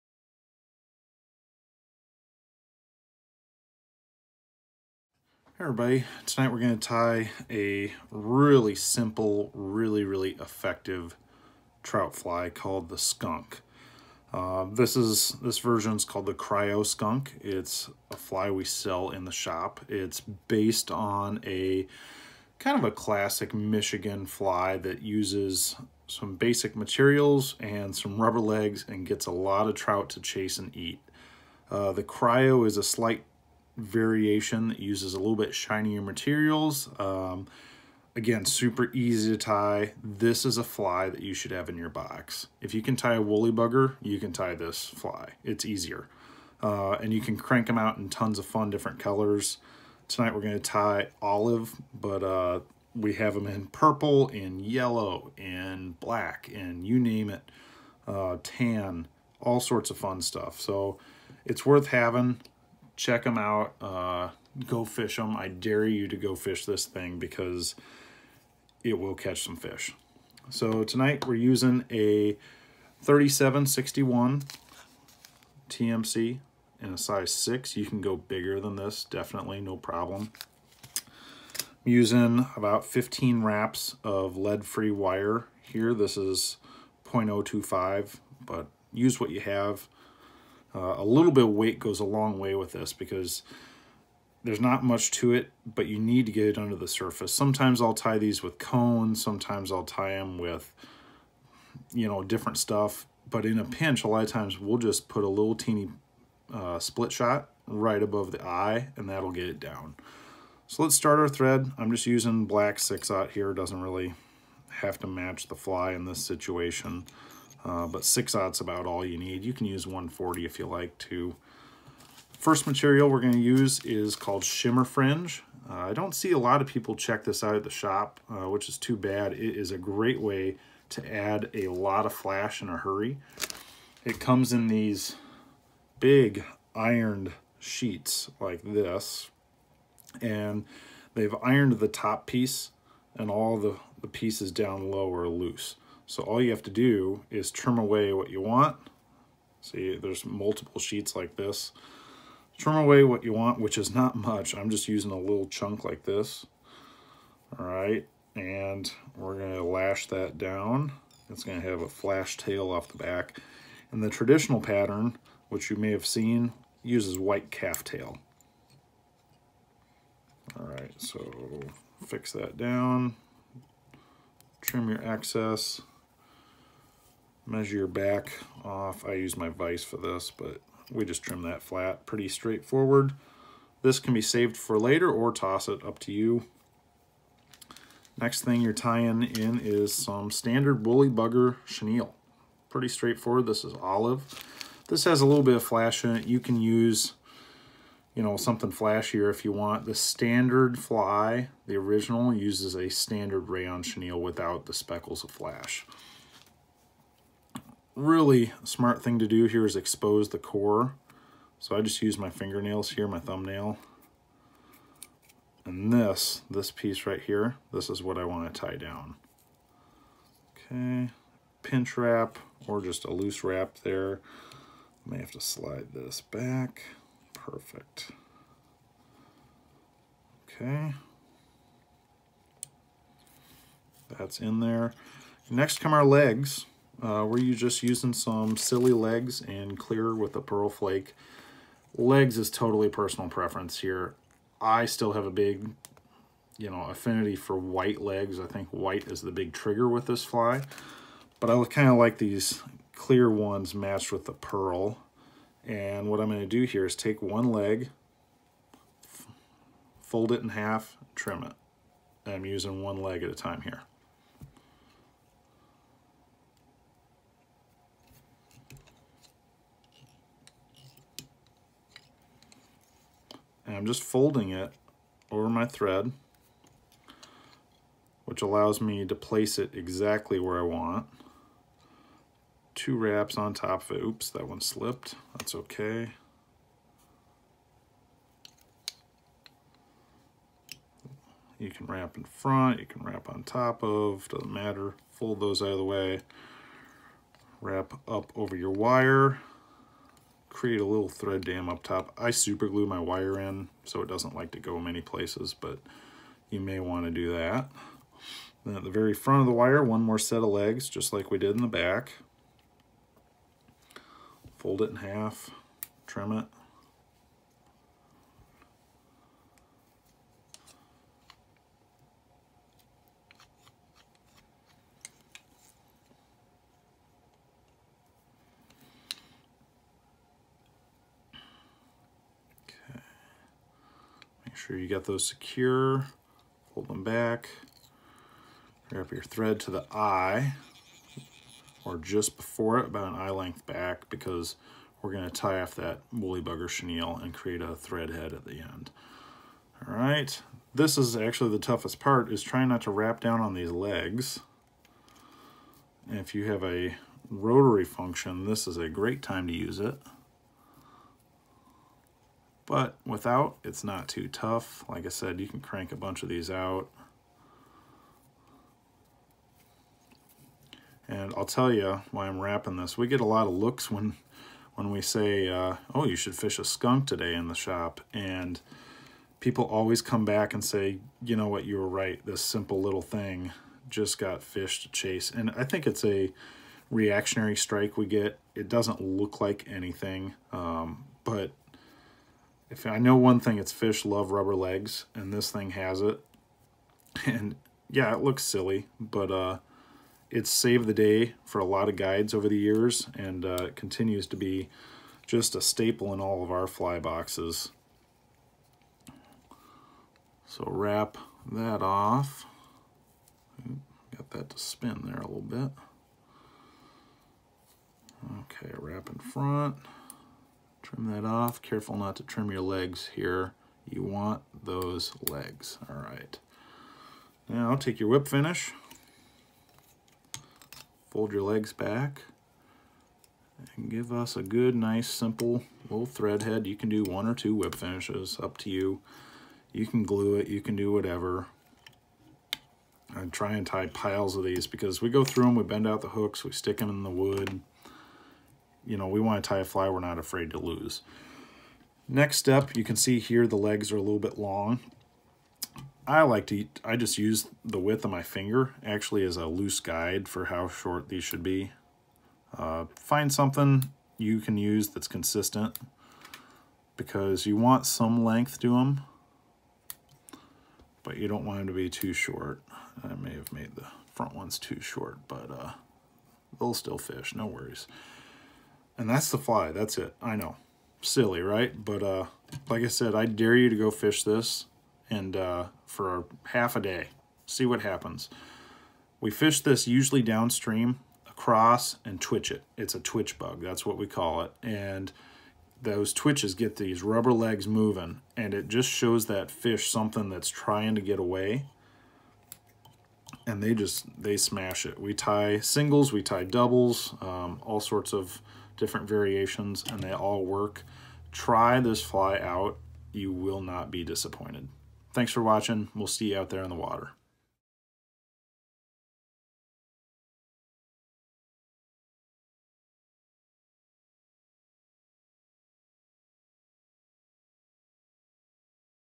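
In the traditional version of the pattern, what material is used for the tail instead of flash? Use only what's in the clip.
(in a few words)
White calf tail.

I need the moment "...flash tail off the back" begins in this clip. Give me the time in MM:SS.
02:41.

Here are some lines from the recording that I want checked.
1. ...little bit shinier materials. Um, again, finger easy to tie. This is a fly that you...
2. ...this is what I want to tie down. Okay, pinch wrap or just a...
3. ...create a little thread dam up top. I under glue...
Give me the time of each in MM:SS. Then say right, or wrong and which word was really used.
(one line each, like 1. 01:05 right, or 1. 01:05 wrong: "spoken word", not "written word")
1. 00:35 wrong: "super", not "finger"
2. 03:37 right
3. 05:00 wrong: "super", not "under".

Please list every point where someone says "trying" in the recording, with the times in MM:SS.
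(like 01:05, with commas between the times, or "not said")
05:52, 08:20.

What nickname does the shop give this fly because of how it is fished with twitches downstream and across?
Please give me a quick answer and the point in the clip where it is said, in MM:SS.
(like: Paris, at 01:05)
Twitch bug, at 08:12.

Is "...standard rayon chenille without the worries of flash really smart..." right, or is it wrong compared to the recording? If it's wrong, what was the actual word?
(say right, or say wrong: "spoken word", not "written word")
wrong: "speckles", not "worries".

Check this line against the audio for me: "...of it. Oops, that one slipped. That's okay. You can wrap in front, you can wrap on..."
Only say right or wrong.
right.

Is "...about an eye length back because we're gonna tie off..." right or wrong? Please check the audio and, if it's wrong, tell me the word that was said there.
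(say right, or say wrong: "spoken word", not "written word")
right.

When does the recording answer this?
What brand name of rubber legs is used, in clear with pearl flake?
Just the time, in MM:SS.
03:58.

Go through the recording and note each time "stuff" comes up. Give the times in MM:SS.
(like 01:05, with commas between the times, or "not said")
01:00, 01:42.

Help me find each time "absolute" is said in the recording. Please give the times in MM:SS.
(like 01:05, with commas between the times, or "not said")
not said.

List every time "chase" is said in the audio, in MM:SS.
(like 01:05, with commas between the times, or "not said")
00:30, 06:24.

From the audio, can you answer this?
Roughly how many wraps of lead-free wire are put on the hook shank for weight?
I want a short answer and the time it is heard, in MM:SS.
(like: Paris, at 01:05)
15, at 01:22.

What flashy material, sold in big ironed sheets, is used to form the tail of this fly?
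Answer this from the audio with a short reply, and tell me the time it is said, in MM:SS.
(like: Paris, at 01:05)
Shimmer Fringe, at 02:04.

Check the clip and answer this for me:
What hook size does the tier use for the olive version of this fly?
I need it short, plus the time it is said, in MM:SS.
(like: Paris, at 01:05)
6, at 01:16.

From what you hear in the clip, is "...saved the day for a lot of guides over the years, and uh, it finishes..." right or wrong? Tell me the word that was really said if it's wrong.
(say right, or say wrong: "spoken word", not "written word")
wrong: "continues", not "finishes".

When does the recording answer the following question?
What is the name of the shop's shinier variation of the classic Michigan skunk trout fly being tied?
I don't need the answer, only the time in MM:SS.
00:16.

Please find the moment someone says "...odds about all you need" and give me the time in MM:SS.
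01:58.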